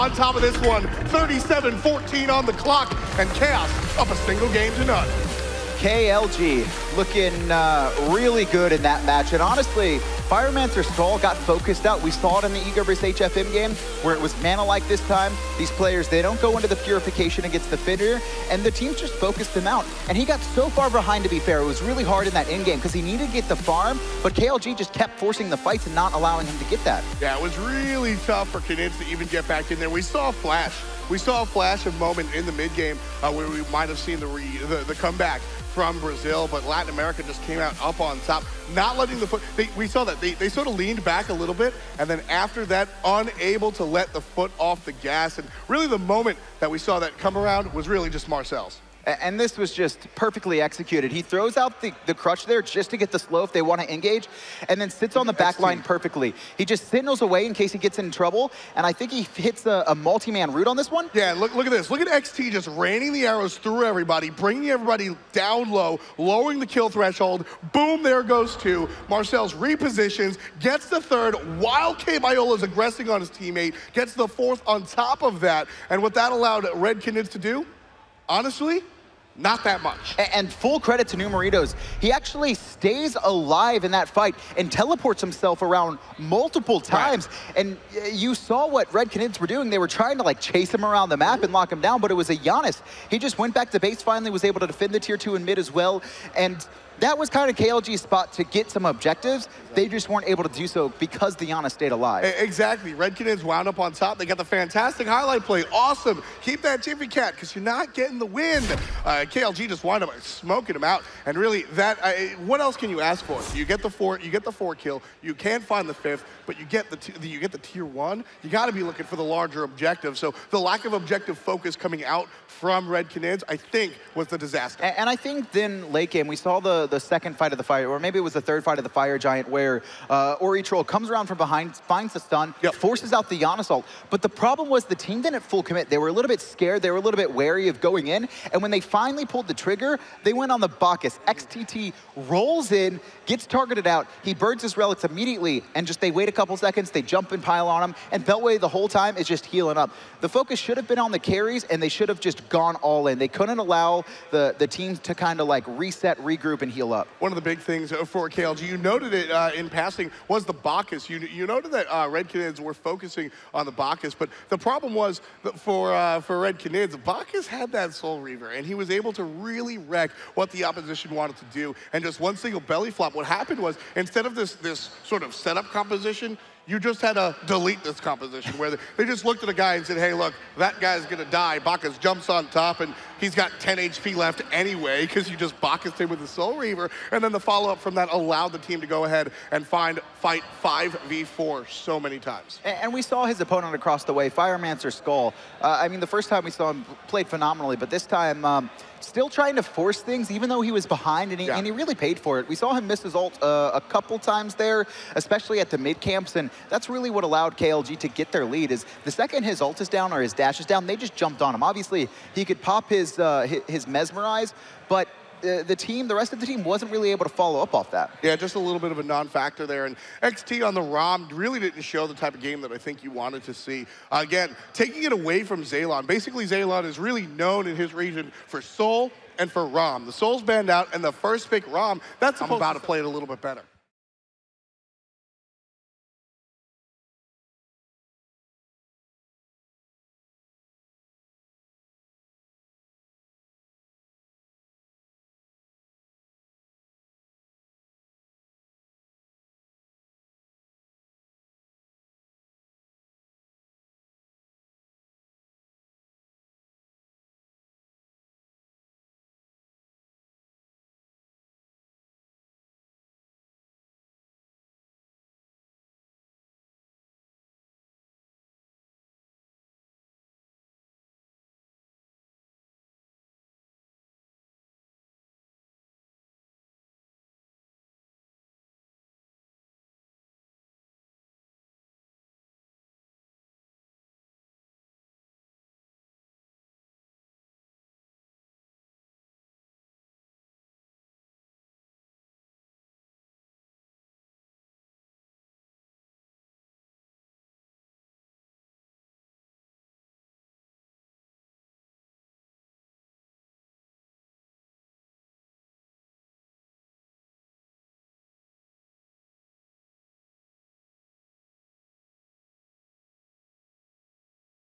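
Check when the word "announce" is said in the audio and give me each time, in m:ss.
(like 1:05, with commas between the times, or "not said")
not said.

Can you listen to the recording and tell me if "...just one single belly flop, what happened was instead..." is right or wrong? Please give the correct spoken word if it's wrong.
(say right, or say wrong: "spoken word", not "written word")
right.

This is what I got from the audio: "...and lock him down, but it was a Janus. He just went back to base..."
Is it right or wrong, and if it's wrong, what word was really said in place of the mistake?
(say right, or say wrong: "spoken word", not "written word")
right.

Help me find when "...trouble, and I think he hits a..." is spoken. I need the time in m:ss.
0:58.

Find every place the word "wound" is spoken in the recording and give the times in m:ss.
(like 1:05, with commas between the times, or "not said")
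1:43, 1:49.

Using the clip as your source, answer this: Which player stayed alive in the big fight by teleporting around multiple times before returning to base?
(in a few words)
Numeritos.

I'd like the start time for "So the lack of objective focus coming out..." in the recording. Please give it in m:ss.
2:00.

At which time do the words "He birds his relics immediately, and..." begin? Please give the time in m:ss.
2:24.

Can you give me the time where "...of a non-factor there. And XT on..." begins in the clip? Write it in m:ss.
3:38.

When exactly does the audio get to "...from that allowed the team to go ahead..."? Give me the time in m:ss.
3:07.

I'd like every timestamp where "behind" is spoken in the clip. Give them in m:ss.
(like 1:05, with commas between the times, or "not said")
0:20, 2:11, 3:20.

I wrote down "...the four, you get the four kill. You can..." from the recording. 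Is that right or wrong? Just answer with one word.
right.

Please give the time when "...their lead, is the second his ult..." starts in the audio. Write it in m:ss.
3:28.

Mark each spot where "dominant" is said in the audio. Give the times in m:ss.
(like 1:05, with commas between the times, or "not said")
not said.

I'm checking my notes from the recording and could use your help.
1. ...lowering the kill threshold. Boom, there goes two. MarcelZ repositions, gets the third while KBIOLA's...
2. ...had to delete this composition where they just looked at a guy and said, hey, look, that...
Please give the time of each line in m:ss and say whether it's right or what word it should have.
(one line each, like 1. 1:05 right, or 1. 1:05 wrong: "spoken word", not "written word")
1. 1:06 right
2. 2:57 right.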